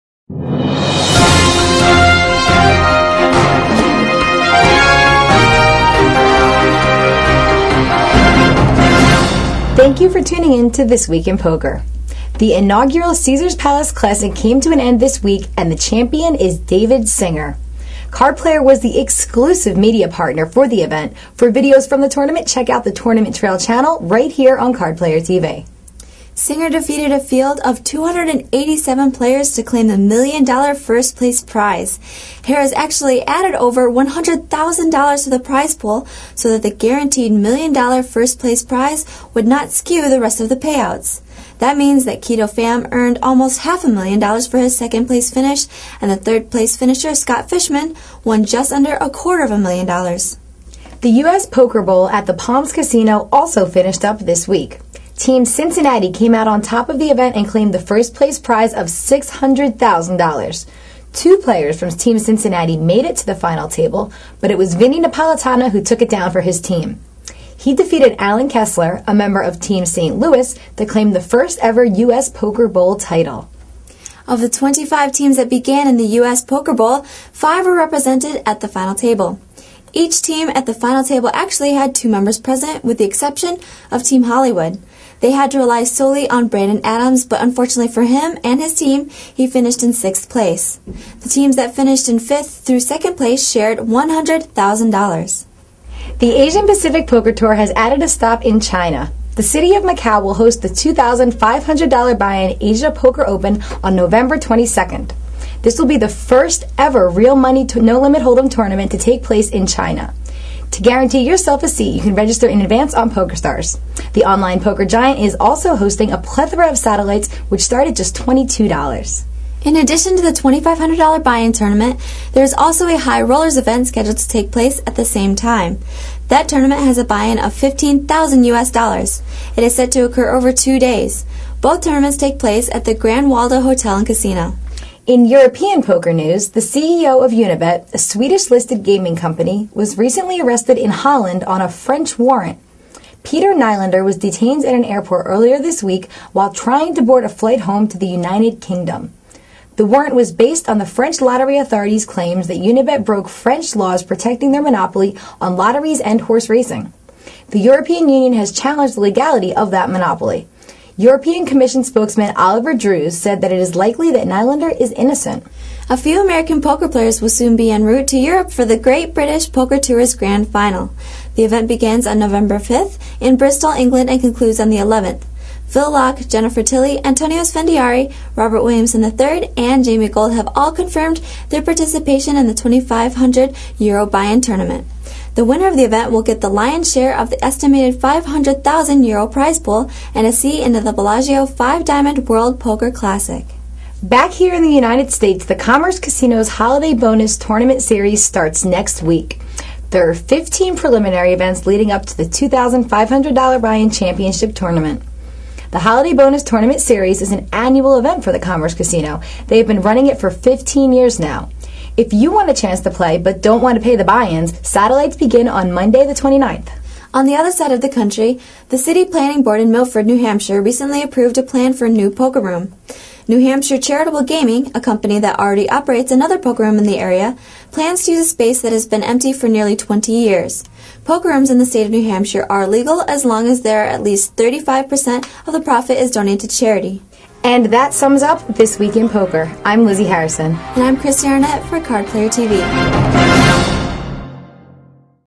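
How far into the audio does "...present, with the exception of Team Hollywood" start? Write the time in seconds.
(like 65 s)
82 s.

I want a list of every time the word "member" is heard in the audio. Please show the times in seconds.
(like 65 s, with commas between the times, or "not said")
69 s, 82 s.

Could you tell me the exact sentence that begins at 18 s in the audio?
Card Player was the exclusive media partner for the event.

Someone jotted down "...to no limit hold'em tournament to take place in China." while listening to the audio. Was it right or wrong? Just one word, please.
right.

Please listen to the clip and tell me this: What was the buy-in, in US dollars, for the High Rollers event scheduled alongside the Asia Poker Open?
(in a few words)
$15,000.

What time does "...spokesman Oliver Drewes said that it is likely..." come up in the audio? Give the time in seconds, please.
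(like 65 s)
161 s.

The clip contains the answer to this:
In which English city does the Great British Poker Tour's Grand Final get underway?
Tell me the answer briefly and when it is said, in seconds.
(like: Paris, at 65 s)
Bristol, at 173 s.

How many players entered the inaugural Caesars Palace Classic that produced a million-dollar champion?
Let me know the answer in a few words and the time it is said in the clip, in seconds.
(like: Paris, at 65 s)
287, at 27 s.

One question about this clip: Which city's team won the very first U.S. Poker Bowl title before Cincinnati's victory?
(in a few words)
St. Louis.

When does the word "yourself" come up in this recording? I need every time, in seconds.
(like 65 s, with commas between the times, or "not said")
111 s.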